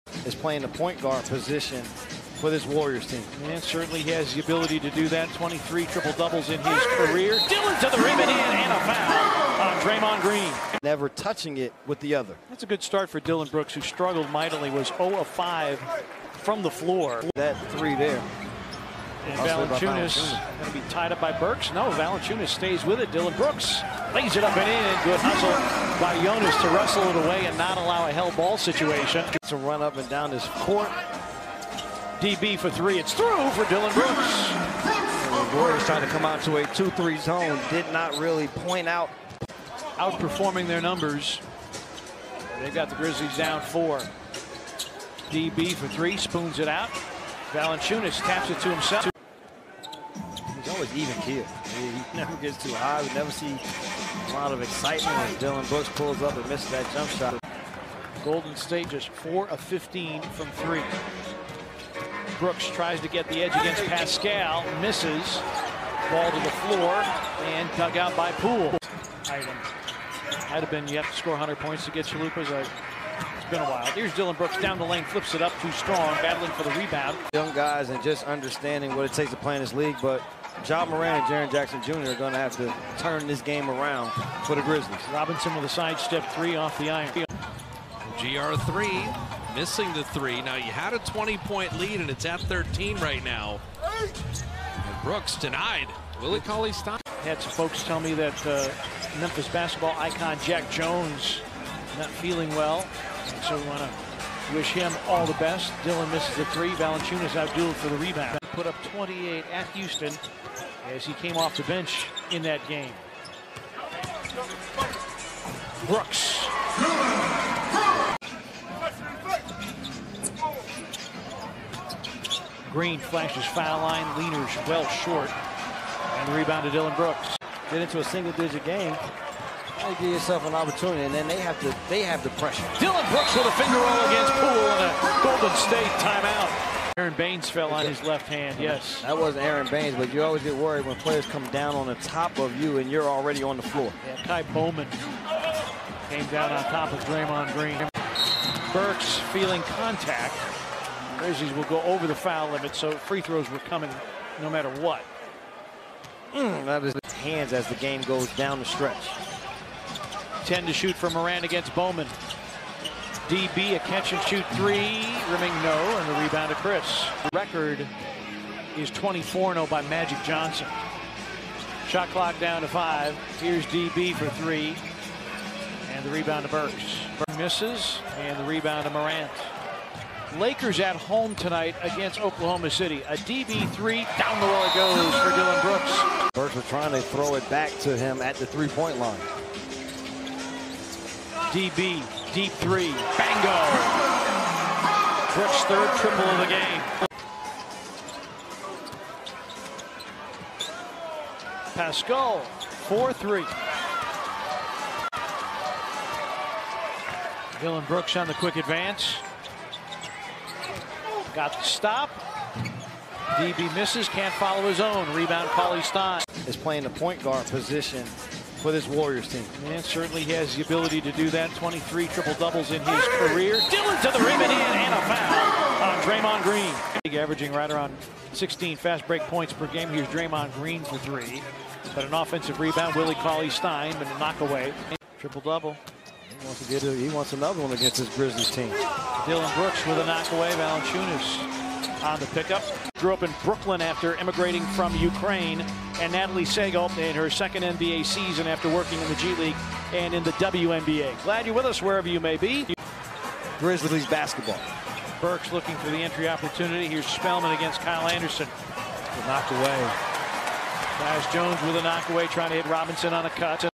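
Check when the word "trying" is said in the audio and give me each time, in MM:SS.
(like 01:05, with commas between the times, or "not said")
00:35, 03:06, 04:22.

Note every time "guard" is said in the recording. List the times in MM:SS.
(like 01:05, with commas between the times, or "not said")
00:01, 03:37.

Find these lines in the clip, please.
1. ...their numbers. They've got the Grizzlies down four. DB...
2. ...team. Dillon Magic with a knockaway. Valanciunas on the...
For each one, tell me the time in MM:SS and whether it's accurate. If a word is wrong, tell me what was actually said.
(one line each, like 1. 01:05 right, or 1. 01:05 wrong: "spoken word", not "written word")
1. 00:40 right
2. 03:58 wrong: "Brooks", not "Magic".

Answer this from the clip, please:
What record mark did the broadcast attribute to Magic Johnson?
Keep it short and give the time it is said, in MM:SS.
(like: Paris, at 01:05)
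24-0, at 02:48.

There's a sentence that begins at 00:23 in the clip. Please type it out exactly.
Dillon Brooks lays it up and in.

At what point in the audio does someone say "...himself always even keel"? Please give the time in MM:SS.
00:48.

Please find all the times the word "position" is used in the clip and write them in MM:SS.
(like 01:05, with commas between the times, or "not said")
00:01, 03:37.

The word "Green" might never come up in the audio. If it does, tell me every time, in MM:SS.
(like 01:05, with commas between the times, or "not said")
00:10, 02:02, 02:27, 03:46, 03:50.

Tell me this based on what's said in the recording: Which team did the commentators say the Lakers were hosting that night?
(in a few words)
Oklahoma City.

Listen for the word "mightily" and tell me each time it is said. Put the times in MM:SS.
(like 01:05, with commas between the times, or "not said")
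00:14.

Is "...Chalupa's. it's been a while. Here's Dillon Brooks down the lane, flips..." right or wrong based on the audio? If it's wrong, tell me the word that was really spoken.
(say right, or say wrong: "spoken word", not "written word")
right.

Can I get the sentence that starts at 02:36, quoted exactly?
Mm, that is his hands as the game goes down the stretch.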